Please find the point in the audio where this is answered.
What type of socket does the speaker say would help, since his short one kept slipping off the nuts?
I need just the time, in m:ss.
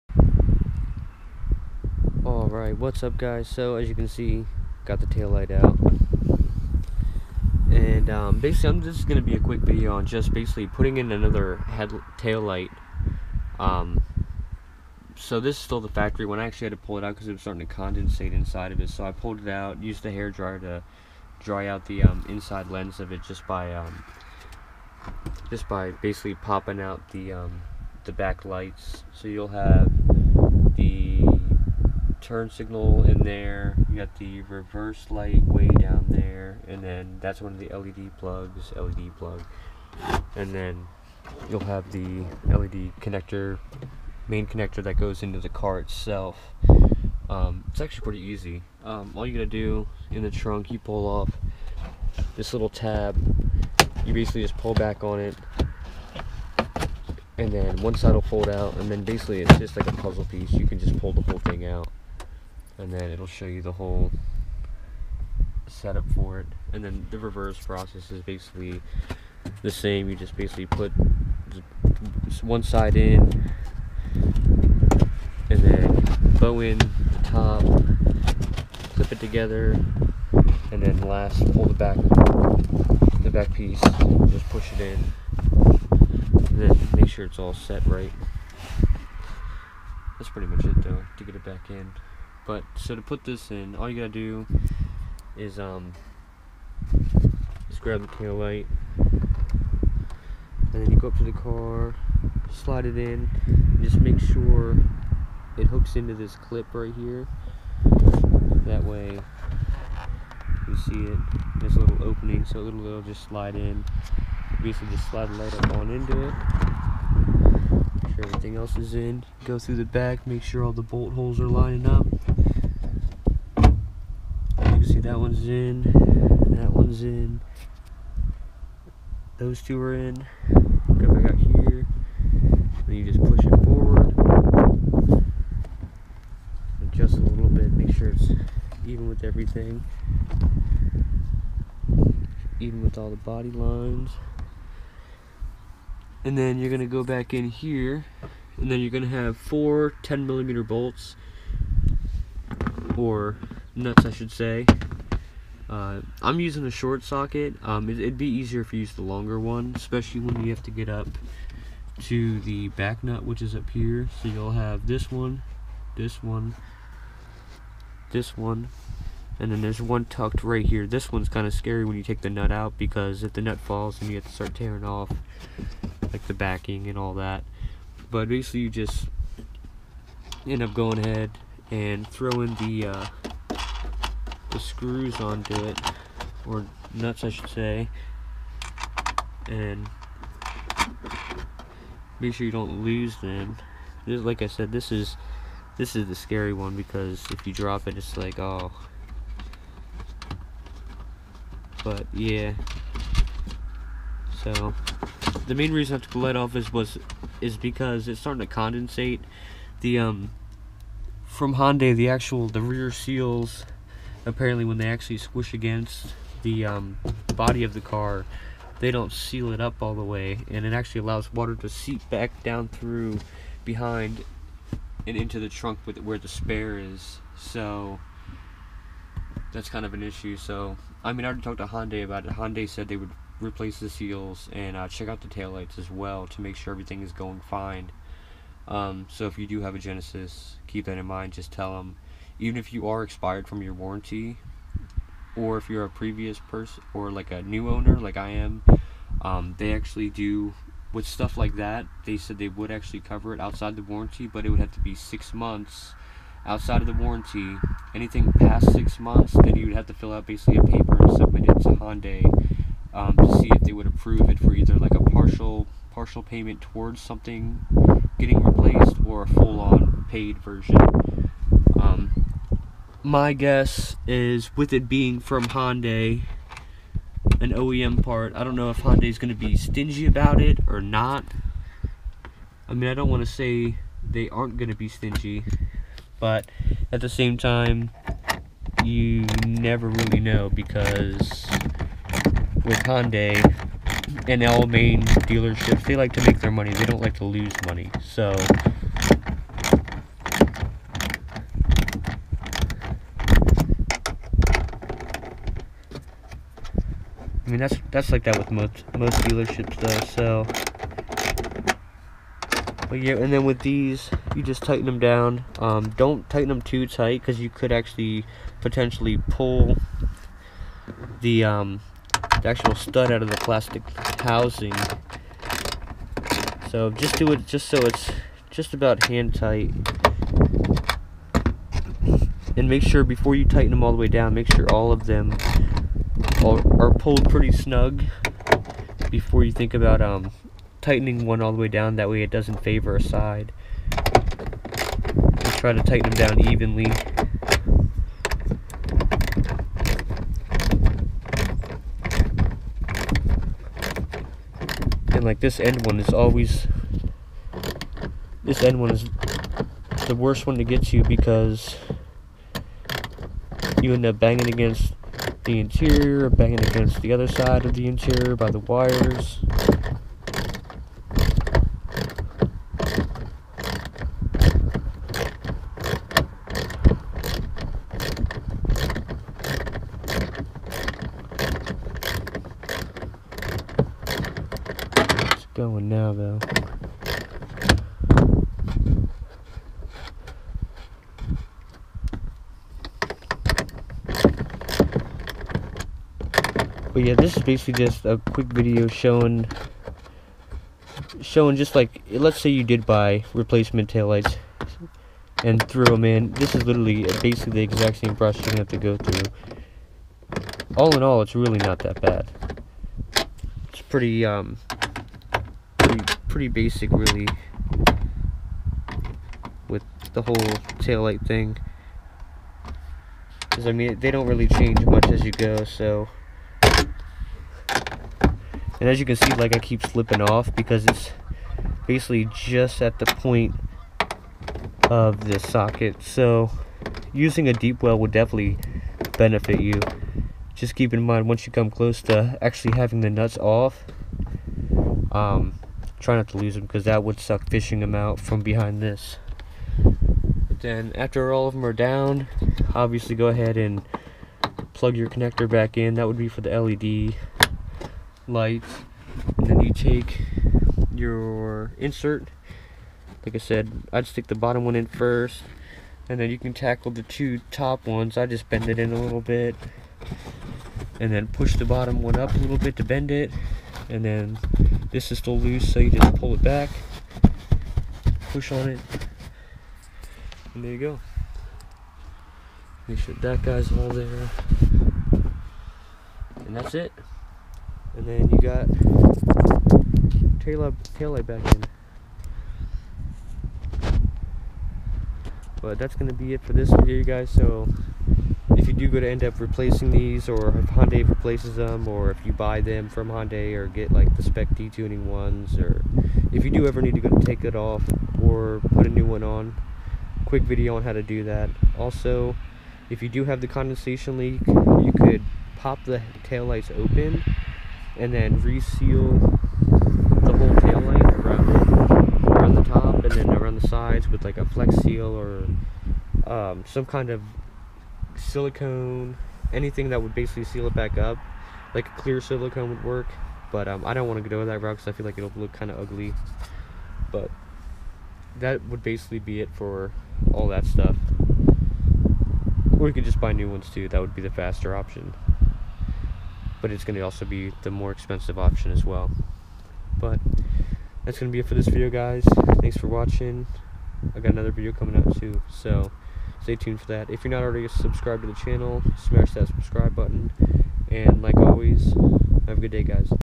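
7:17.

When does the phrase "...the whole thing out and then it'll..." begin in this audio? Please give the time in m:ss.
1:01.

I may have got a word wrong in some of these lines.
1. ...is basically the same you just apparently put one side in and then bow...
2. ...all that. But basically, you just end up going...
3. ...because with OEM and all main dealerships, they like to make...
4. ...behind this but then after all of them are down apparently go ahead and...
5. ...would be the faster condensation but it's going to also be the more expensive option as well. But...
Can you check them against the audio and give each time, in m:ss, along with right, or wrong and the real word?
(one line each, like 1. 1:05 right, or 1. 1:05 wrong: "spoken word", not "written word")
1. 1:08 wrong: "basically", not "apparently"
2. 2:56 right
3. 4:50 wrong: "Hyundai", not "OEM"
4. 7:28 wrong: "obviously", not "apparently"
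5. 9:04 wrong: "option", not "condensation".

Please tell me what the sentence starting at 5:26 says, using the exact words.
So just do it just so it's just about hand tight.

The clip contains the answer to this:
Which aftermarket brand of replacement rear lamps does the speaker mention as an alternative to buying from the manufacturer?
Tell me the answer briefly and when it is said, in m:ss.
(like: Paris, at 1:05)
Spec-D Tuning, at 8:24.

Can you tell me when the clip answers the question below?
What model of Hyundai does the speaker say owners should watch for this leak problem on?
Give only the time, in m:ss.
3:59.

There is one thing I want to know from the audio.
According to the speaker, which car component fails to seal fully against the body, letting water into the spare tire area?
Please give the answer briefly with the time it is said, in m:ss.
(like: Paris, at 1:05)
Rear seals, at 3:32.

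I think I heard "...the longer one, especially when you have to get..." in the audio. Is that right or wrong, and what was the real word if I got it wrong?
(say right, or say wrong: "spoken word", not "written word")
right.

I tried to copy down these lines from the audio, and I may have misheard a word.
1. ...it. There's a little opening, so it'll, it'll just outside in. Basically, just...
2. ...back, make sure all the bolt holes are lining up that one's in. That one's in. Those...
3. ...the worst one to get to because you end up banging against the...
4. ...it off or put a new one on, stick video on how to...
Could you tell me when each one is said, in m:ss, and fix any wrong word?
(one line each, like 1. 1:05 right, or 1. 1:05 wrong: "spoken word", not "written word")
1. 1:51 wrong: "slide", not "outside"
2. 1:59 right
3. 6:00 right
4. 8:27 wrong: "quick", not "stick".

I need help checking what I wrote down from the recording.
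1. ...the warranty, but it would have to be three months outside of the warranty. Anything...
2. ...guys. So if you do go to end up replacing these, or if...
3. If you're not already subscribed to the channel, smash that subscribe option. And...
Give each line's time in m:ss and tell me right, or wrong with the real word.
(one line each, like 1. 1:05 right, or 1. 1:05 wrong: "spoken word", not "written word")
1. 4:13 wrong: "six", not "three"
2. 8:17 right
3. 9:17 wrong: "button", not "option".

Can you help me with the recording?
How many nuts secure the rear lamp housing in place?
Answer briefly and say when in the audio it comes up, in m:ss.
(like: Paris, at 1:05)
4, at 2:29.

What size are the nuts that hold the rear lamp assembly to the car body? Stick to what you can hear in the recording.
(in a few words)
10 millimeter.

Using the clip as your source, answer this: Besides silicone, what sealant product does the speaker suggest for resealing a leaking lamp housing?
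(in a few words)
Flex Seal.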